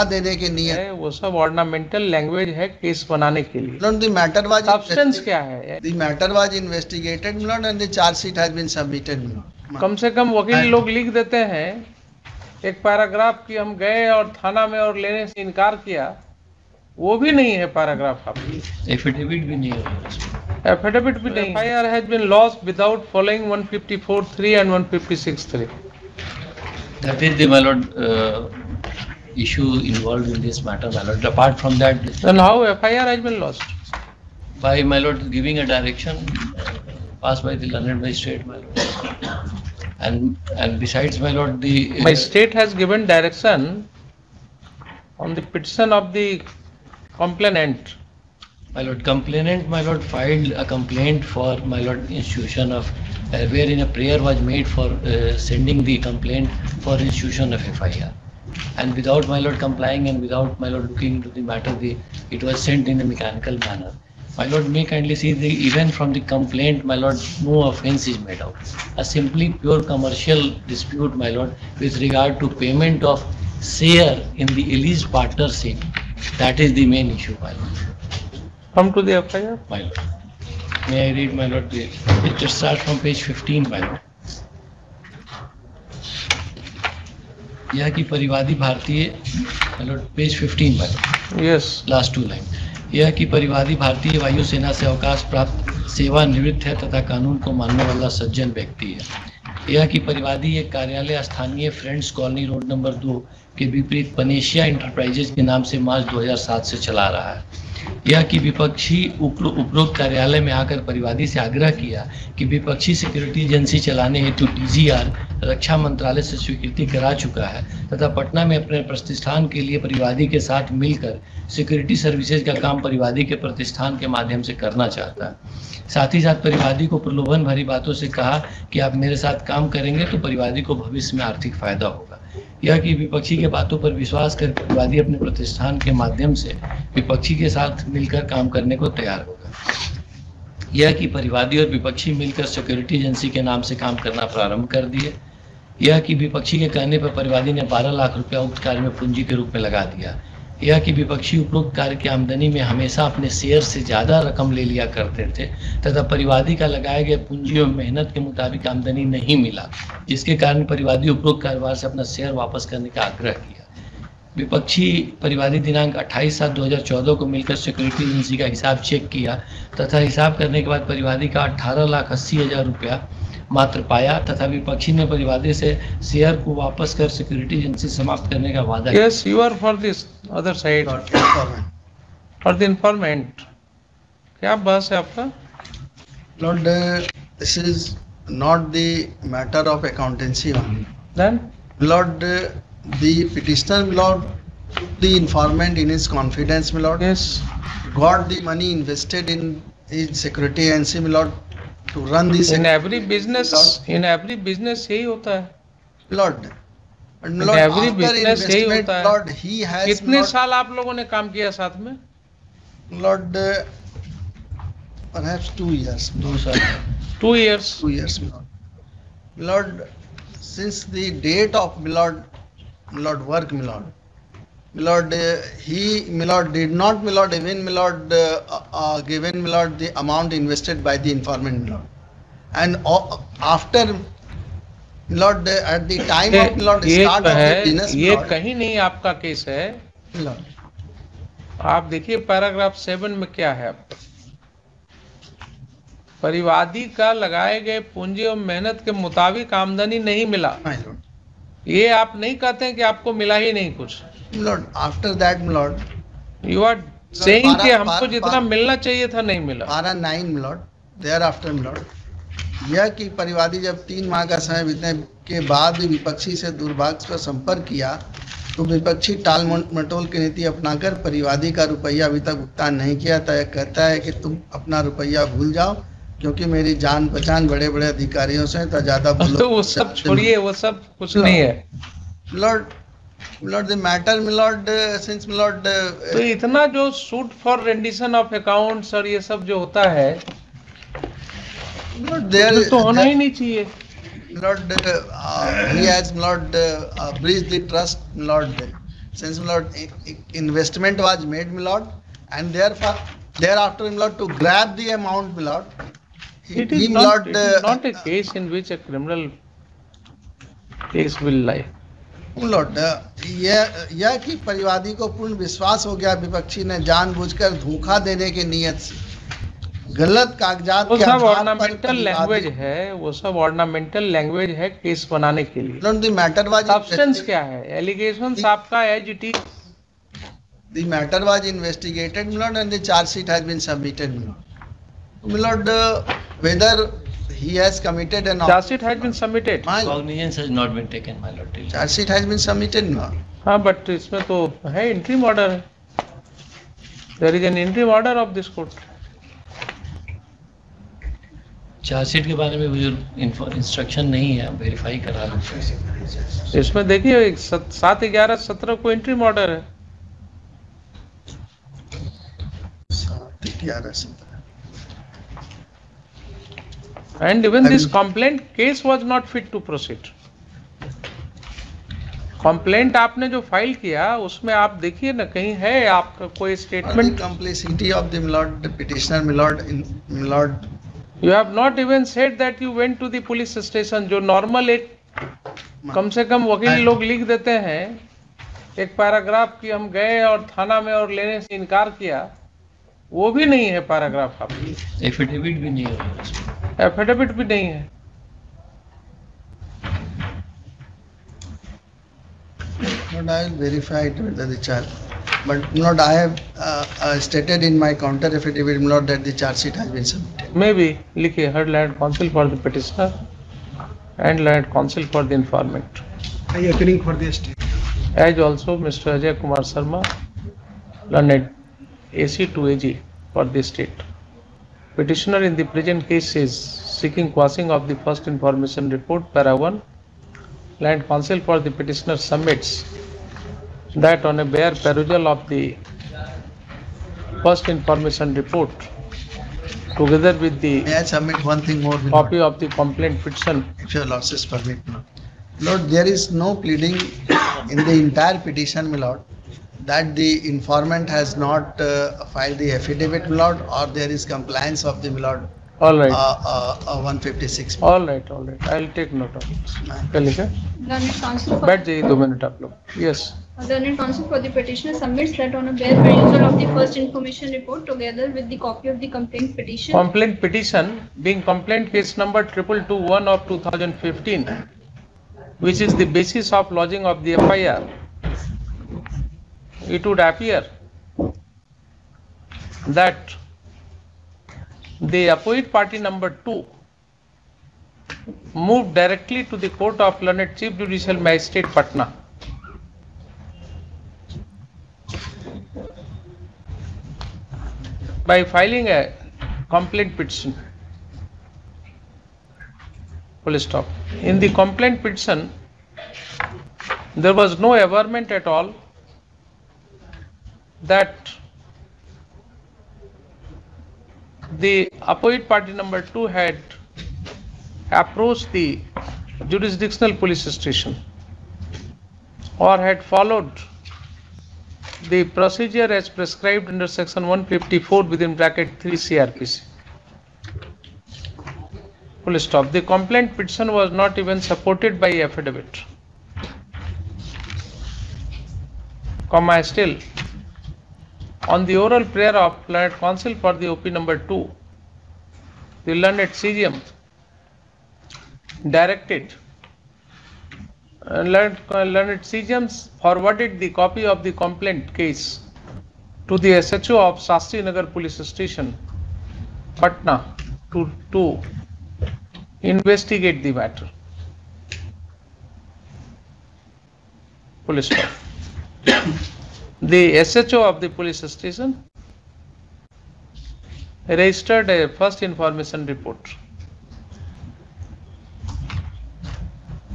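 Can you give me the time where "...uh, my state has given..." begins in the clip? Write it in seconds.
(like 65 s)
41 s.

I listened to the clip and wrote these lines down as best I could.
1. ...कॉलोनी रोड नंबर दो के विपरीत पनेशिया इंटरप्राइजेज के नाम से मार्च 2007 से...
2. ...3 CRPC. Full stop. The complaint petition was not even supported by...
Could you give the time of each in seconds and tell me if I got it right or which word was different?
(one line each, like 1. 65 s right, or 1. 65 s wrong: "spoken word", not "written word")
1. 102 s right
2. 528 s right.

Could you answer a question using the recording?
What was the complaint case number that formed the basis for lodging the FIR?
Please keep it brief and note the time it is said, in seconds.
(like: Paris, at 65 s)
221 of 2015, at 472 s.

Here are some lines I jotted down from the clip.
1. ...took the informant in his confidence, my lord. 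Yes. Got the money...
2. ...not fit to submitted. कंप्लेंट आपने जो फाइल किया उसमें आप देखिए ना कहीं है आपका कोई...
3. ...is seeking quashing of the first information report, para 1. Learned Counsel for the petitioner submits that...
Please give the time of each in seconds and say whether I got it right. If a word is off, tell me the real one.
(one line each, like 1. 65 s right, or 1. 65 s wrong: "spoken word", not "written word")
1. 194 s right
2. 369 s wrong: "proceed", not "submitted"
3. 426 s right.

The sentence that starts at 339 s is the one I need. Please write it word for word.
My cognizance has not been taken, my lord.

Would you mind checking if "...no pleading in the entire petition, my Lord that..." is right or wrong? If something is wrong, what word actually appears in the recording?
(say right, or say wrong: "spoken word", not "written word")
right.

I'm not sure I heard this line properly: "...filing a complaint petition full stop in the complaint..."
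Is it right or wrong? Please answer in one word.
right.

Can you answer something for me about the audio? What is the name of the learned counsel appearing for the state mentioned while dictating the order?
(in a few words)
Ajay Kumar Sharma.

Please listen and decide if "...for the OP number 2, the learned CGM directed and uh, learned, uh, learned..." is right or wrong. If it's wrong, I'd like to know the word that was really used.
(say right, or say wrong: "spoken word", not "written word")
right.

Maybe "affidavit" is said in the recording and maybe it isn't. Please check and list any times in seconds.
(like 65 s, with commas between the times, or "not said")
408 s, 452 s, 535 s.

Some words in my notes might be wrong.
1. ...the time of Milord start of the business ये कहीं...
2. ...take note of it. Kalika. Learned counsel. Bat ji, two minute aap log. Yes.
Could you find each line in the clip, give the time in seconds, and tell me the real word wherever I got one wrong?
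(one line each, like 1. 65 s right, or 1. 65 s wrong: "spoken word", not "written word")
1. 235 s right
2. 458 s right.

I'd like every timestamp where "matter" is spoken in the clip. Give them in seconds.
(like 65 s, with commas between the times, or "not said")
30 s, 61 s, 563 s.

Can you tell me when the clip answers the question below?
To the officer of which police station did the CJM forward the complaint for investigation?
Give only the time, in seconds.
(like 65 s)
557 s.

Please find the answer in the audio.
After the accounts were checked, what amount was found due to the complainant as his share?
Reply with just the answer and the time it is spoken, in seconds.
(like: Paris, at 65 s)
18 lakh 80 thousand rupees, at 171 s.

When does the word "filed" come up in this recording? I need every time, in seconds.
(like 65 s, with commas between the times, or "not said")
50 s, 452 s.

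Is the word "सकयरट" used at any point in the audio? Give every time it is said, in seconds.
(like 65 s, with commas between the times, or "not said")
112 s, 121 s, 142 s, 167 s, 177 s.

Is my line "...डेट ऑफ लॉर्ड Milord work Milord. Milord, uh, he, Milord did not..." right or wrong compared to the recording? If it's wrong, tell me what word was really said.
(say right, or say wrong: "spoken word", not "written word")
right.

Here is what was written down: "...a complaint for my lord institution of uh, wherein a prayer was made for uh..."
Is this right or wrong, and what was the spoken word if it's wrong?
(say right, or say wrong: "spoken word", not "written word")
right.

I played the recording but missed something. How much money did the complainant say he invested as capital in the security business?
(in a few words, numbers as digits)
12 lakh rupees.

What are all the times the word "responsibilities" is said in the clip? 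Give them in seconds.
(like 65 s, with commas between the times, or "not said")
not said.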